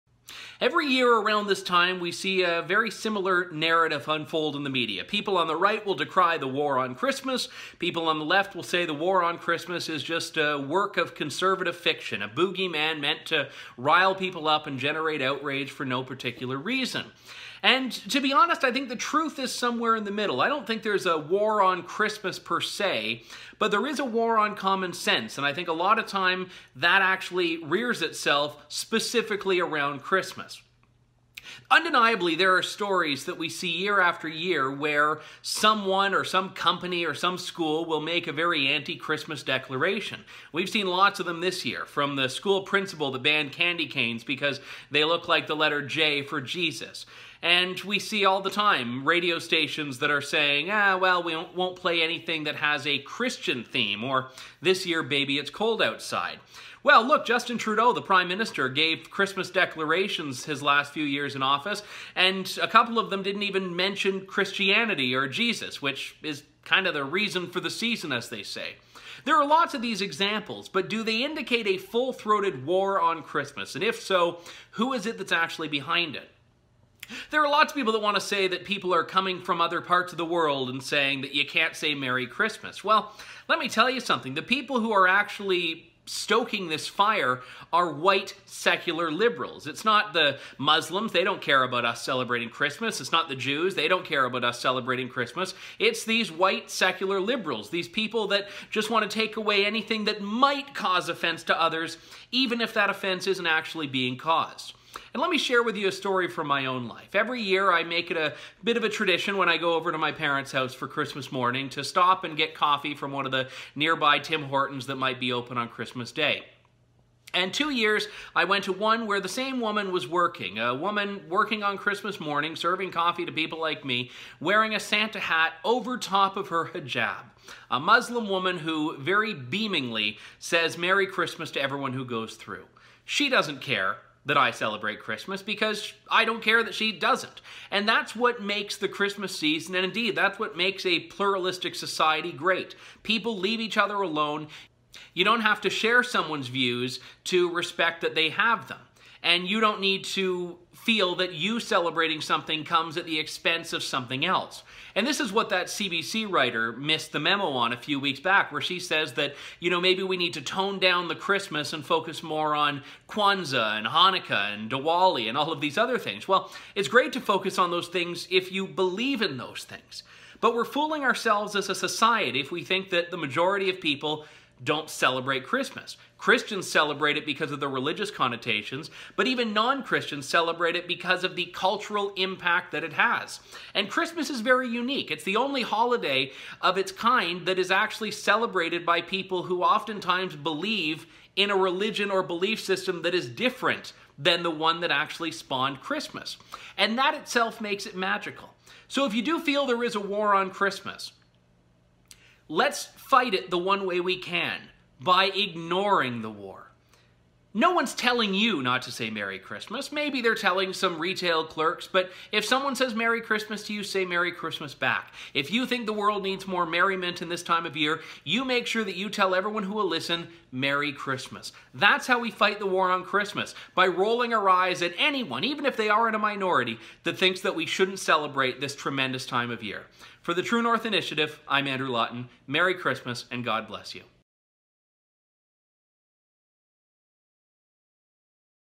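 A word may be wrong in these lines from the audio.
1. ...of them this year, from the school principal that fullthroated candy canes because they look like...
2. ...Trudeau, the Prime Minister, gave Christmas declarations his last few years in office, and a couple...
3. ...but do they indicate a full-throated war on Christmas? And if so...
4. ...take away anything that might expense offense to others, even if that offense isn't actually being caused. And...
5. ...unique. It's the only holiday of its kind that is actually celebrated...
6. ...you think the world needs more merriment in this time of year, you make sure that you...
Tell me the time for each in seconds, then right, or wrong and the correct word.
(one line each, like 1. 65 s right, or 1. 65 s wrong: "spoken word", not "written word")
1. 41 s wrong: "banned", not "fullthroated"
2. 57 s right
3. 70 s right
4. 99 s wrong: "cause", not "expense"
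5. 184 s right
6. 215 s right.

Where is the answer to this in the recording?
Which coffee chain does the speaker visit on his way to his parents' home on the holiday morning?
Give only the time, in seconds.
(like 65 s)
114 s.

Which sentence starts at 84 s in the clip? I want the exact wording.
The people who are actually stoking this fire are white secular liberals.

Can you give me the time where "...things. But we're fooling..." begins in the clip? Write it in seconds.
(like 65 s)
169 s.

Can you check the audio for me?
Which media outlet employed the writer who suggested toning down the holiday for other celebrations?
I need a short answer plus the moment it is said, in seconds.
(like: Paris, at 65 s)
CBC, at 155 s.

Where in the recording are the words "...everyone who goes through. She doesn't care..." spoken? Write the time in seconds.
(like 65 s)
131 s.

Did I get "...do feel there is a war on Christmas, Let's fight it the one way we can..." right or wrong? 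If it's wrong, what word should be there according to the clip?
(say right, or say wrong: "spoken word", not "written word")
right.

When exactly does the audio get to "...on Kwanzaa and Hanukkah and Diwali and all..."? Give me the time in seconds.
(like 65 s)
162 s.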